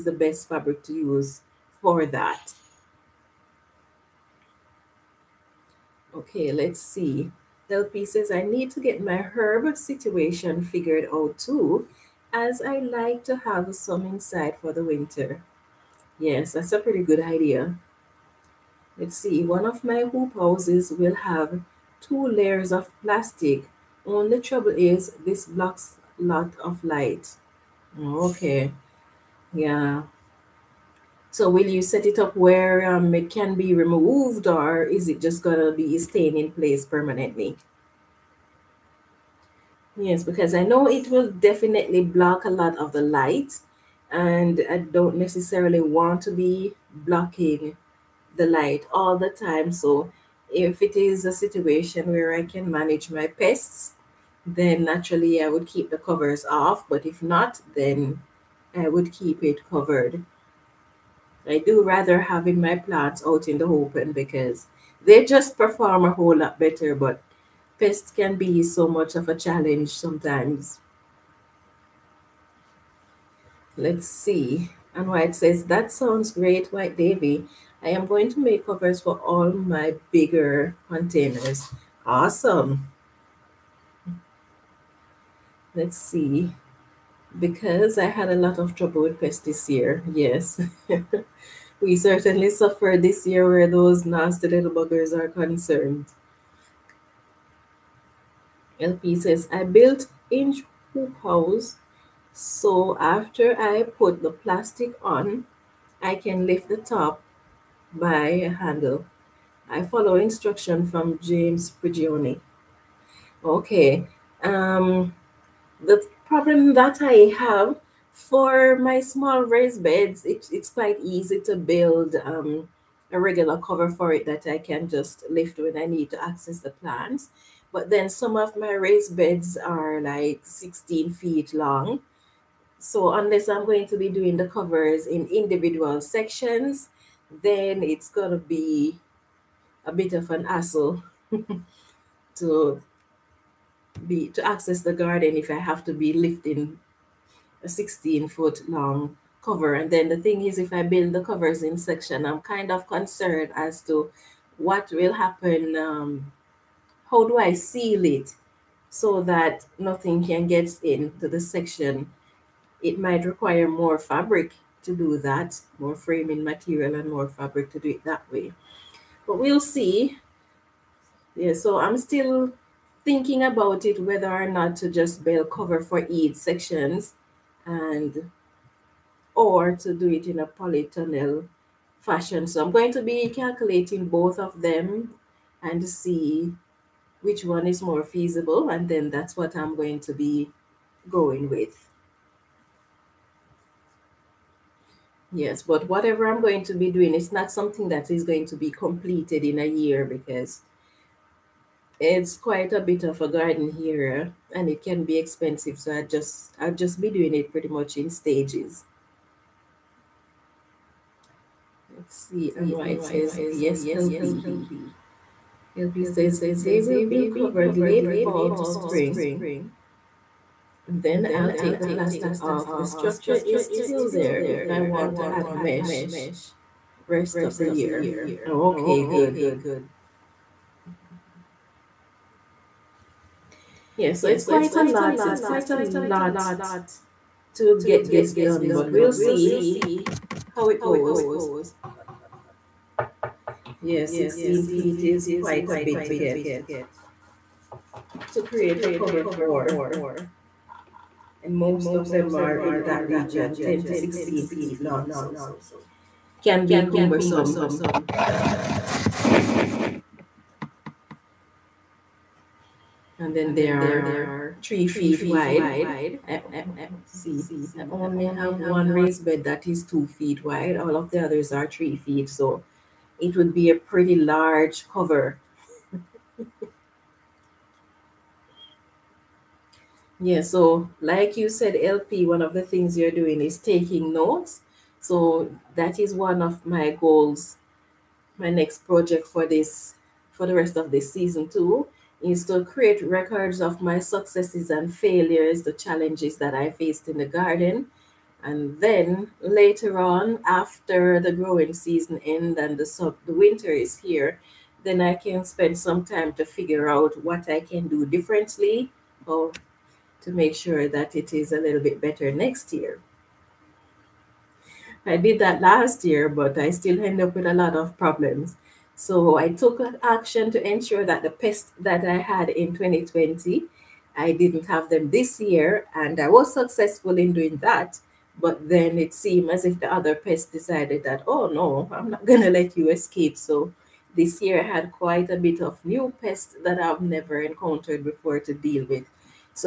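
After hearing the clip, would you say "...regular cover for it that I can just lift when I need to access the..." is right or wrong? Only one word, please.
right.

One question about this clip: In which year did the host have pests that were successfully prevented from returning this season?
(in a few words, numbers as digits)
2020.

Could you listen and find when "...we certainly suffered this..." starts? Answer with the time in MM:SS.
01:31.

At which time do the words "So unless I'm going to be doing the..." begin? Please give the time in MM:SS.
02:12.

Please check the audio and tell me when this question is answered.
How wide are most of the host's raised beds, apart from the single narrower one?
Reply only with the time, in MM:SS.
04:24.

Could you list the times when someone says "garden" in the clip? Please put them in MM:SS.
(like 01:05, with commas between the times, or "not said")
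02:24, 03:23, 04:57.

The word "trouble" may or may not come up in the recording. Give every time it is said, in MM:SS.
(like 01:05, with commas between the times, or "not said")
00:24, 01:28.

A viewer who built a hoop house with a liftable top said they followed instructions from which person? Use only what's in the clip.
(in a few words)
James Prigioni.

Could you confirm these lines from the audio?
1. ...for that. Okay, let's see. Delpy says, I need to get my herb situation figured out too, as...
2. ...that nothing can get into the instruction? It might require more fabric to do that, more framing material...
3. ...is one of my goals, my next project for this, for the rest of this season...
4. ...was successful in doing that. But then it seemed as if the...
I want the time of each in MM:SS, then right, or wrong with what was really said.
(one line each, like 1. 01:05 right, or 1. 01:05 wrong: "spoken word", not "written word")
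1. 00:01 right
2. 02:39 wrong: "section", not "instruction"
3. 04:45 right
4. 05:26 right.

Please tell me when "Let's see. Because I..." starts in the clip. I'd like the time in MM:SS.
01:25.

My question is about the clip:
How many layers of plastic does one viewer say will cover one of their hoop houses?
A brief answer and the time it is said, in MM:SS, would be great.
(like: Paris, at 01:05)
2, at 00:21.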